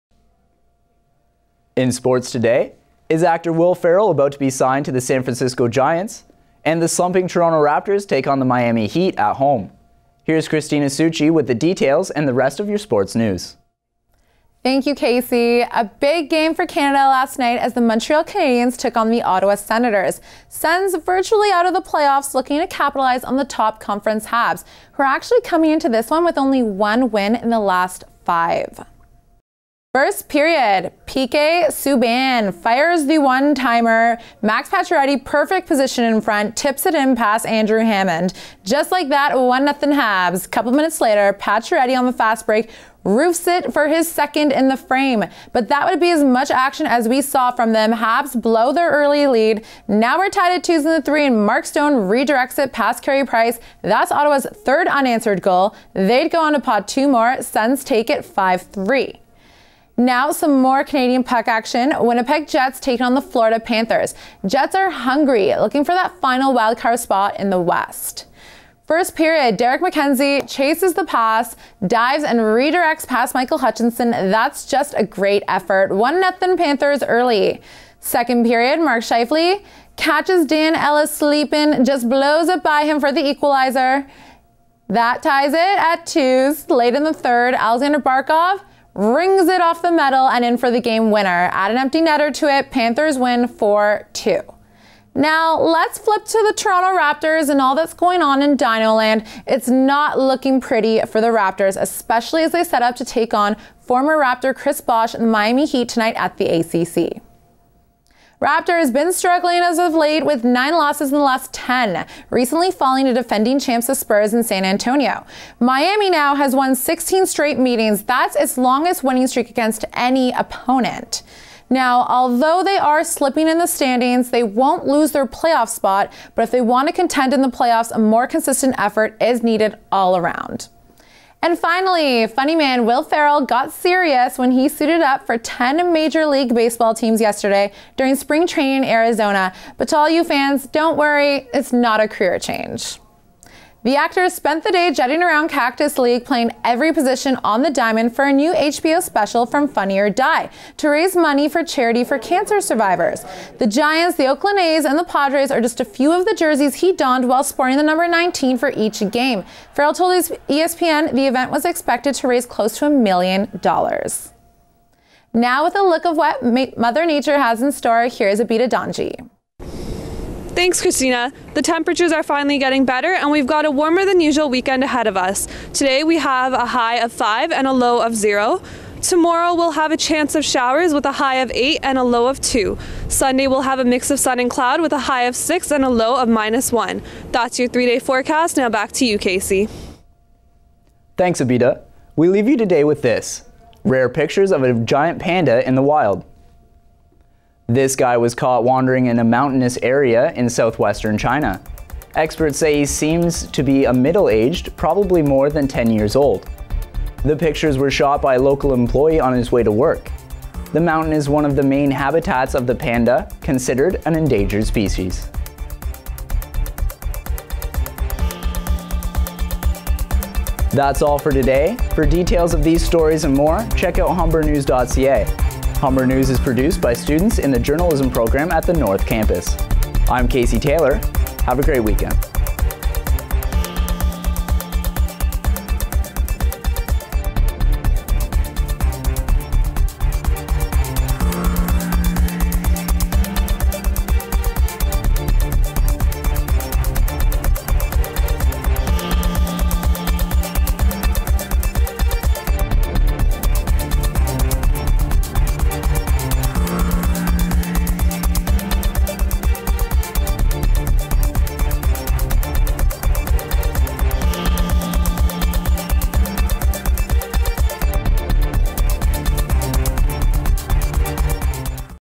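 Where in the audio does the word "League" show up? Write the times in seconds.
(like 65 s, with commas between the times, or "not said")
136 s, 145 s.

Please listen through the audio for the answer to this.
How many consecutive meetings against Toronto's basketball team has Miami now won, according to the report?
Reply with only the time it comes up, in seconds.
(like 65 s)
116 s.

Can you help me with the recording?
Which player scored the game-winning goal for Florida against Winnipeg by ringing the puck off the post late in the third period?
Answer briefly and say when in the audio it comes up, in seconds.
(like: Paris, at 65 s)
Alexander Barkov, at 87 s.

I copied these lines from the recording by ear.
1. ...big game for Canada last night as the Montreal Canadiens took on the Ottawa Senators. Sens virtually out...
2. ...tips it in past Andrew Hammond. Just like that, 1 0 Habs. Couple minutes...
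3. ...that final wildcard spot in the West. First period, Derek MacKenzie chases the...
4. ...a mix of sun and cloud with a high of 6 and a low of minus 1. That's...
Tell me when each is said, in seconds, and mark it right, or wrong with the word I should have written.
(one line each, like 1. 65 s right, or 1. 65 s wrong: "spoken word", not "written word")
1. 15 s right
2. 36 s right
3. 65 s right
4. 183 s right.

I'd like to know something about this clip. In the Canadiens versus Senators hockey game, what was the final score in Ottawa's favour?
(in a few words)
5-3.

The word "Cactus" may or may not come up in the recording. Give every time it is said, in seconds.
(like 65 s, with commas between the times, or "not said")
145 s.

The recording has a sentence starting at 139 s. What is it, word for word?
But to all you fans, don't worry, it's not a career change.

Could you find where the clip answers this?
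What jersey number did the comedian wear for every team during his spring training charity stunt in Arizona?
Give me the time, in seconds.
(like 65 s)
158 s.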